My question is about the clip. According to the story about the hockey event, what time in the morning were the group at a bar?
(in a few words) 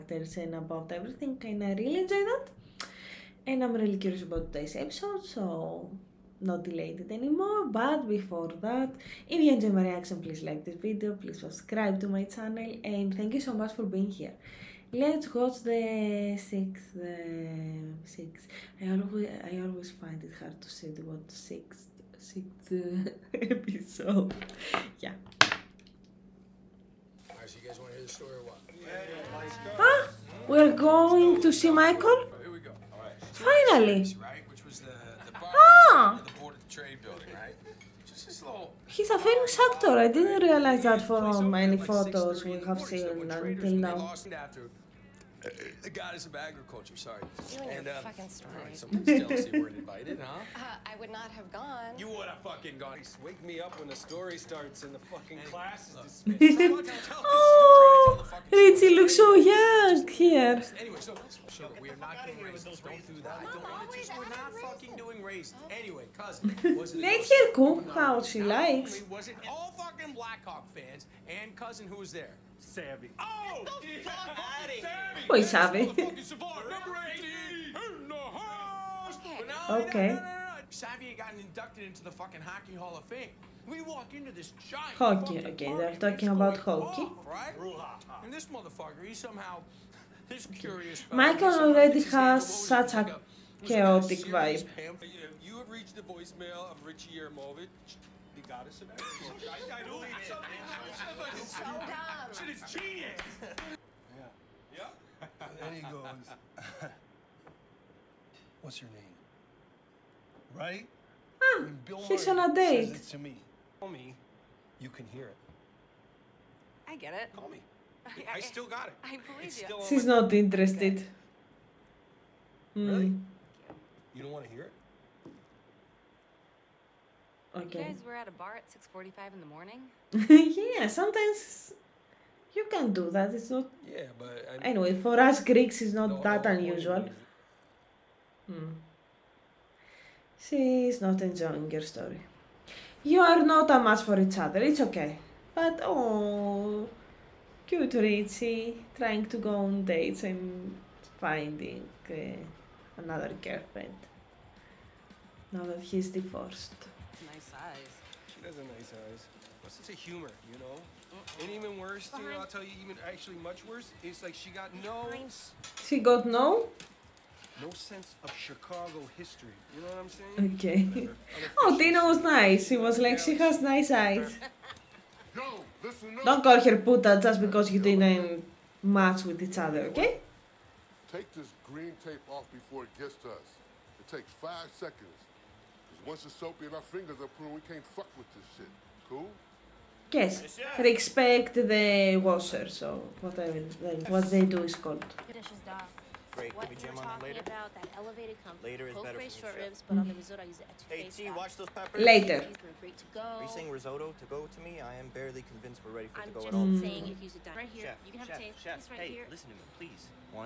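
6:45.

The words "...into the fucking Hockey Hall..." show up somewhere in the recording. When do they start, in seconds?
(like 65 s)
81 s.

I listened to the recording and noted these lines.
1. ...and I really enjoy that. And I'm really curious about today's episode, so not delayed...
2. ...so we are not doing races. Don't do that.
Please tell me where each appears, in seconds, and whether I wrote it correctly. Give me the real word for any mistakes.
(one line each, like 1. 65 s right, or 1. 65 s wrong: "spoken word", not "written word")
1. 1 s right
2. 61 s right.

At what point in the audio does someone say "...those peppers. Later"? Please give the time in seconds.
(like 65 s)
201 s.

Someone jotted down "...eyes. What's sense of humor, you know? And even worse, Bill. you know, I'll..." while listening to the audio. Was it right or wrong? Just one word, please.
wrong.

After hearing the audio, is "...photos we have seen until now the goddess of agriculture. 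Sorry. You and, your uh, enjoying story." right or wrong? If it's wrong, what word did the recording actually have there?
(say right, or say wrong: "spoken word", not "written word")
wrong: "fucking", not "enjoying".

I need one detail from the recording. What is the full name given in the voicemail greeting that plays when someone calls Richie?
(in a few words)
Richie Jerimovich.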